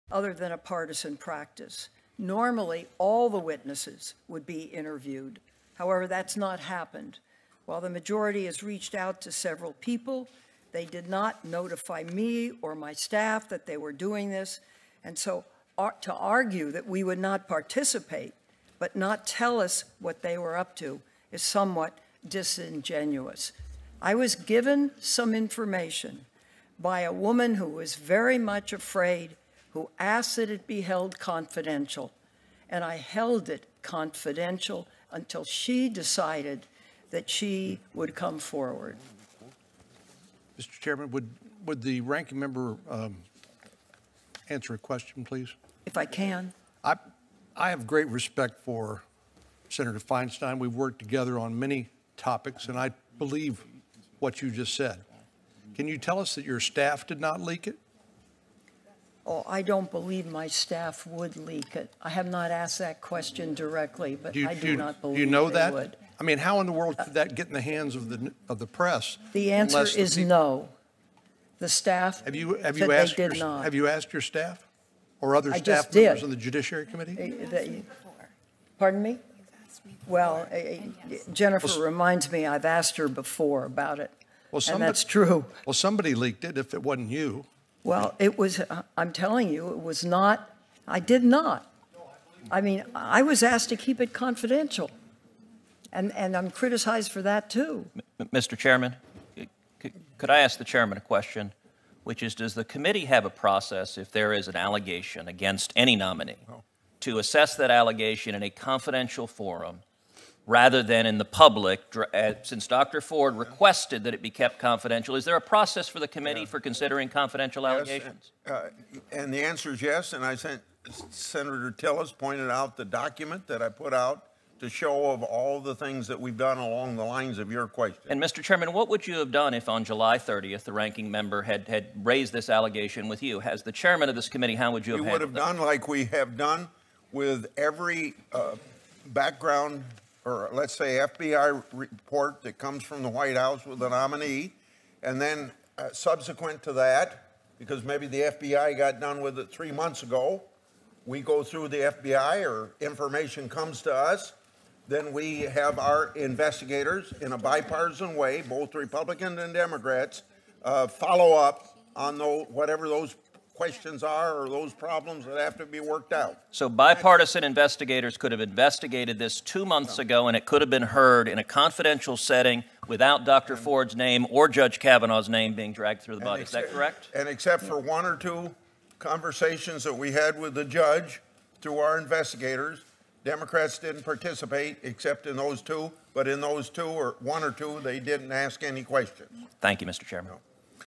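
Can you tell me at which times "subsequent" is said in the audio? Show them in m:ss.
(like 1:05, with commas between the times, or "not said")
2:25.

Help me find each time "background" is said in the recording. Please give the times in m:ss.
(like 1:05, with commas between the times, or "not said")
2:19.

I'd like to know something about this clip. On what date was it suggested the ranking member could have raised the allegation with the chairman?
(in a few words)
July 30th.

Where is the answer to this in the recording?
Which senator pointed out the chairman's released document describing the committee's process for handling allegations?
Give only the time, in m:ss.
2:01.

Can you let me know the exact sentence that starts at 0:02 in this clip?
Normally, all the witnesses would be interviewed.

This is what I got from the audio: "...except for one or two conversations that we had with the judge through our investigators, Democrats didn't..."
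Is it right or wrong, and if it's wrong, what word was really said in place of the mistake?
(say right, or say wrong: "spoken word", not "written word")
right.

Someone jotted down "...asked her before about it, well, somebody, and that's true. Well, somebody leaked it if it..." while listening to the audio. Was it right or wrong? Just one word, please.
right.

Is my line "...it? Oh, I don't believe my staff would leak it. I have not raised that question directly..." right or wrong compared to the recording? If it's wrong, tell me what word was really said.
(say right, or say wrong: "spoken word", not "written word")
wrong: "asked", not "raised".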